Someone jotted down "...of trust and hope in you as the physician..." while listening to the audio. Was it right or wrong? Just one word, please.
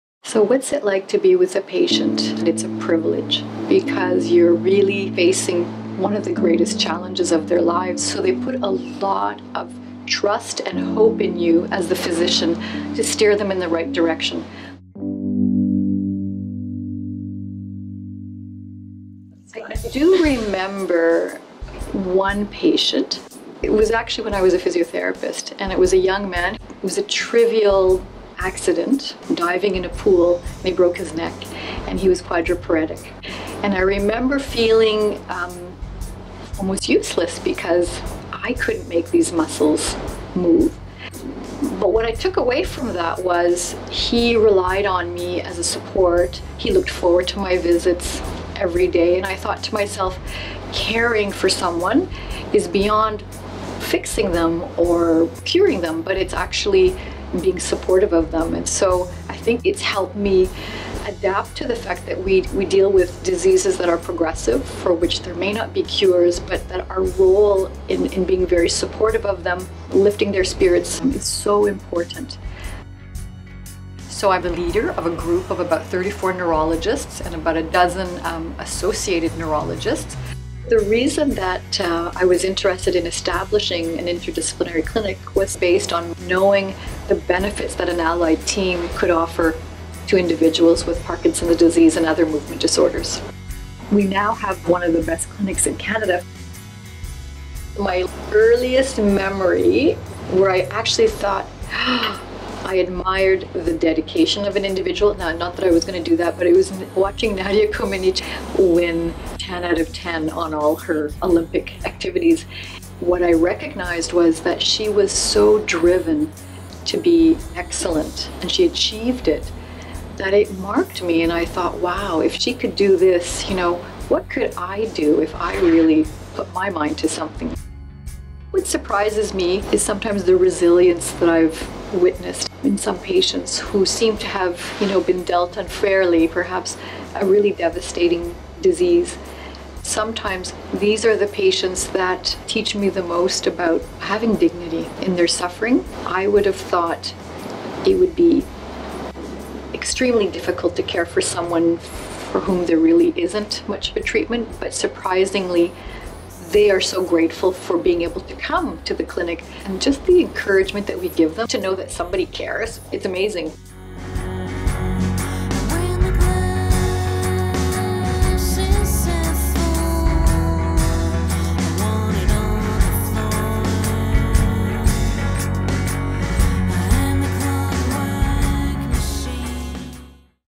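right.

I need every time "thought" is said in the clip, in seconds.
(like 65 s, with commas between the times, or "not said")
49 s, 101 s, 121 s, 146 s.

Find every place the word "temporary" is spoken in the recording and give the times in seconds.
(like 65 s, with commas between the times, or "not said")
not said.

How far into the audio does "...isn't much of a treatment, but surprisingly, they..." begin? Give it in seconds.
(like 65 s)
153 s.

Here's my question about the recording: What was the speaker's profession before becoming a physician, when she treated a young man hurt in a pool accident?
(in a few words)
Physiotherapist.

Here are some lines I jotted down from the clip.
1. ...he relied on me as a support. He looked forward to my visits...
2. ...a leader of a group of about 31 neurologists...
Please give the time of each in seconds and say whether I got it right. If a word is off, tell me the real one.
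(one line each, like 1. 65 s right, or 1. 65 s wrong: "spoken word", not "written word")
1. 43 s right
2. 74 s wrong: "34", not "31".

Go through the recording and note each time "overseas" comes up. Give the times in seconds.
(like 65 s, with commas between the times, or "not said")
not said.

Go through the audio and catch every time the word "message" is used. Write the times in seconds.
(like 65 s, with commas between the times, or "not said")
not said.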